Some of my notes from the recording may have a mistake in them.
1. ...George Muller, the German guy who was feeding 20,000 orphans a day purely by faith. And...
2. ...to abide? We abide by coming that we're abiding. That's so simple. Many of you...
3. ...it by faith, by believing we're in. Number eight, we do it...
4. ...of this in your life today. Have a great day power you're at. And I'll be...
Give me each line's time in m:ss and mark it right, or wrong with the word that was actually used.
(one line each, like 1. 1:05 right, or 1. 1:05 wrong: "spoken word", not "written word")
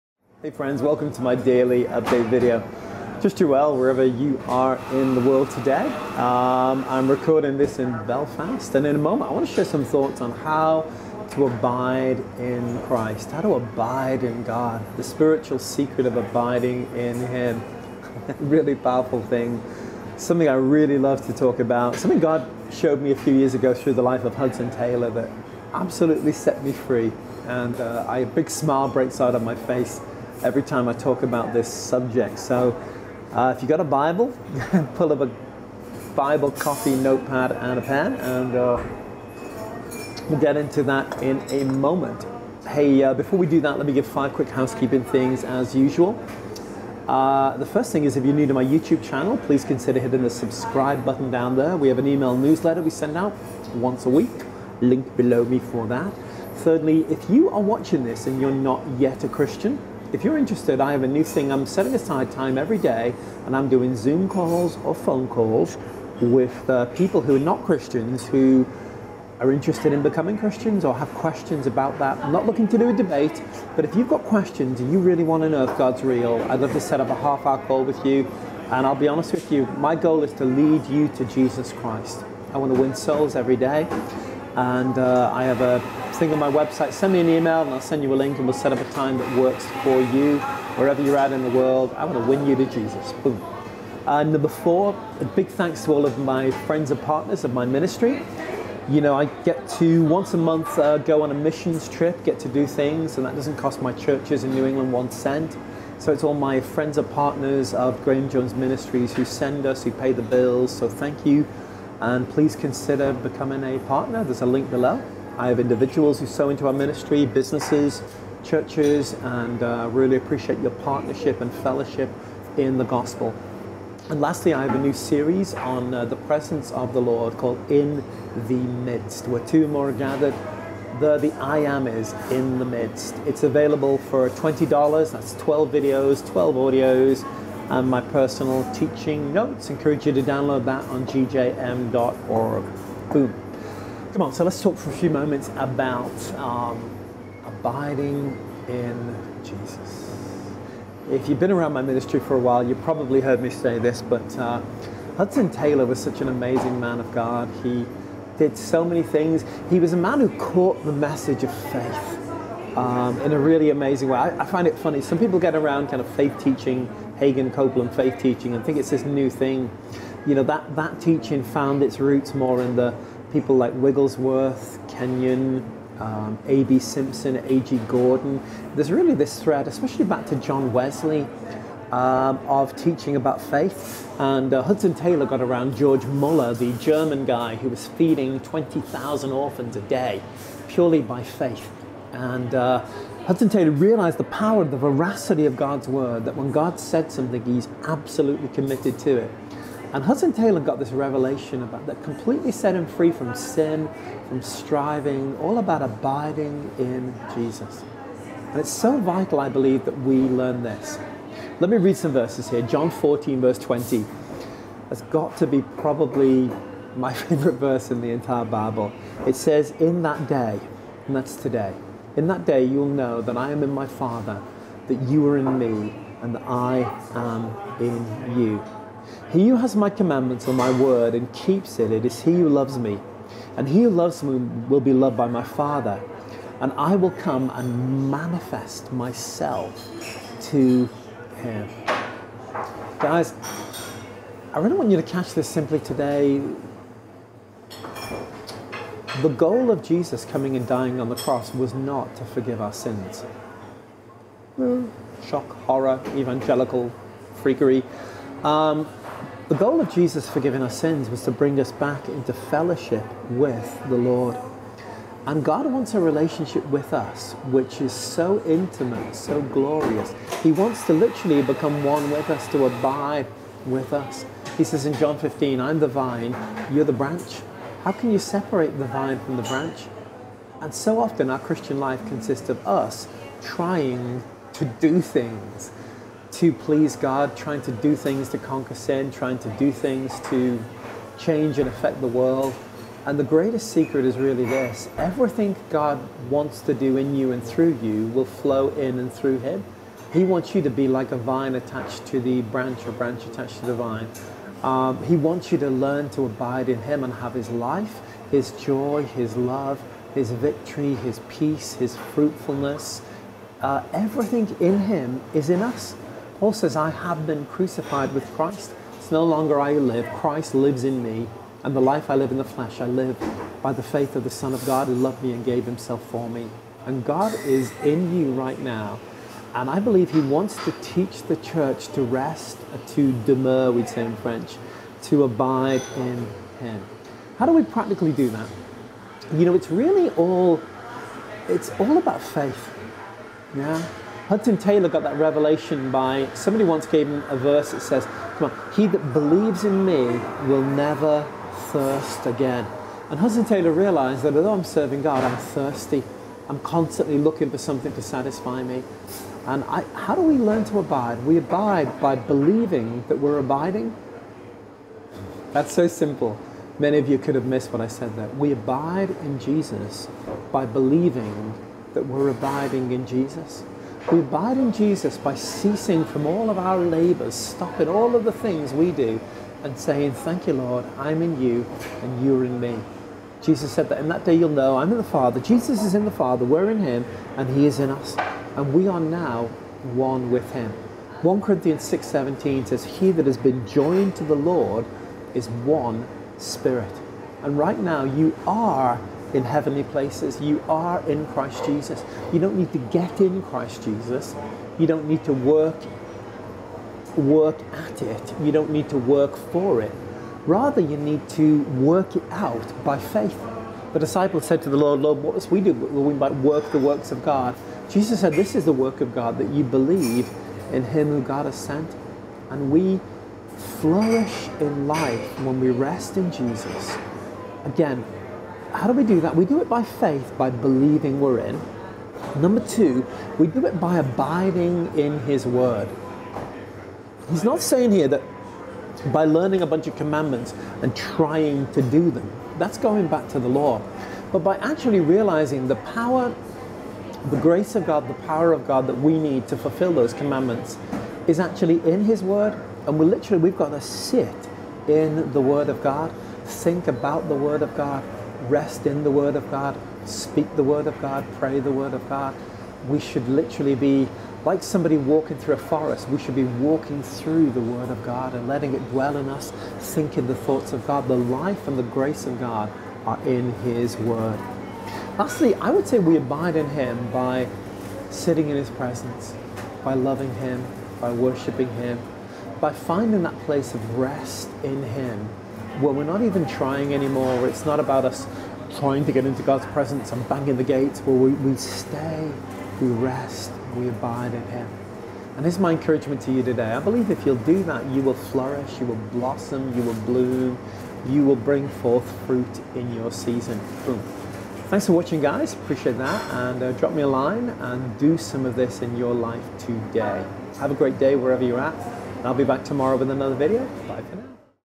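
1. 3:05 right
2. 6:00 wrong: "believing", not "coming"
3. 7:09 wrong: "two", not "eight"
4. 8:28 wrong: "wherever", not "power".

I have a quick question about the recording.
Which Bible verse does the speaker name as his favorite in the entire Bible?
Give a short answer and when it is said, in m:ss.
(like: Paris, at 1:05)
John 14:20, at 3:32.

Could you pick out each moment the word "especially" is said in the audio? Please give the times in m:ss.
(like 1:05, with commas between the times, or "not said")
2:59.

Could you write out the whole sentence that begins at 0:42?
Hey, uh, before we do that, let me give five quick housekeeping things as usual.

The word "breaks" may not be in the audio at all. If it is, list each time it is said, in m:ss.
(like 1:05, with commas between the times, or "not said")
0:28.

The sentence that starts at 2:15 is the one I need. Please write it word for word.
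That's 12 videos, 12 audios, and my personal teaching notes.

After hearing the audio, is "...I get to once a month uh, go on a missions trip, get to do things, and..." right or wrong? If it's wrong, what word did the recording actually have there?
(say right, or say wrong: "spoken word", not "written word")
right.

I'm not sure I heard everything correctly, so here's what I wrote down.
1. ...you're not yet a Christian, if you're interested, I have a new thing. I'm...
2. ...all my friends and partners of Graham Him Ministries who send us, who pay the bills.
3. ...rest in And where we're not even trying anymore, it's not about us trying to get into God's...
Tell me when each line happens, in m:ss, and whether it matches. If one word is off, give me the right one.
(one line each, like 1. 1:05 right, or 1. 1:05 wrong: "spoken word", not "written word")
1. 0:58 right
2. 1:46 wrong: "Jones", not "Him"
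3. 8:03 wrong: "Him", not "And".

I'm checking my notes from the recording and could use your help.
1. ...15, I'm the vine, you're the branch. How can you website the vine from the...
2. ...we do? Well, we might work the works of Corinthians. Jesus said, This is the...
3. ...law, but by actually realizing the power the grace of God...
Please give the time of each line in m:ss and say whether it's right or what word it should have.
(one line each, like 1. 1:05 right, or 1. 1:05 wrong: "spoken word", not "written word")
1. 4:35 wrong: "separate", not "website"
2. 6:55 wrong: "God", not "Corinthians"
3. 7:23 right.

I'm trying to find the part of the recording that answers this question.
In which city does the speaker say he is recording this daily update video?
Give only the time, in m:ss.
0:08.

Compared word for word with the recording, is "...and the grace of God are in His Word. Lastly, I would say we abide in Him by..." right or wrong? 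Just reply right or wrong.
right.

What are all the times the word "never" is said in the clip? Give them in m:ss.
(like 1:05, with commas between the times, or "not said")
5:50.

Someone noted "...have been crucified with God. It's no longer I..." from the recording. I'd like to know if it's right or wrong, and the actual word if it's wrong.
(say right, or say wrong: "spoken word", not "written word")
wrong: "Christ", not "God".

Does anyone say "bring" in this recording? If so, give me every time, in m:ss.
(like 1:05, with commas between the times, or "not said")
4:21, 8:21.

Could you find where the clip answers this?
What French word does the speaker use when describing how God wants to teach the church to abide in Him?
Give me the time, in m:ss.
5:33.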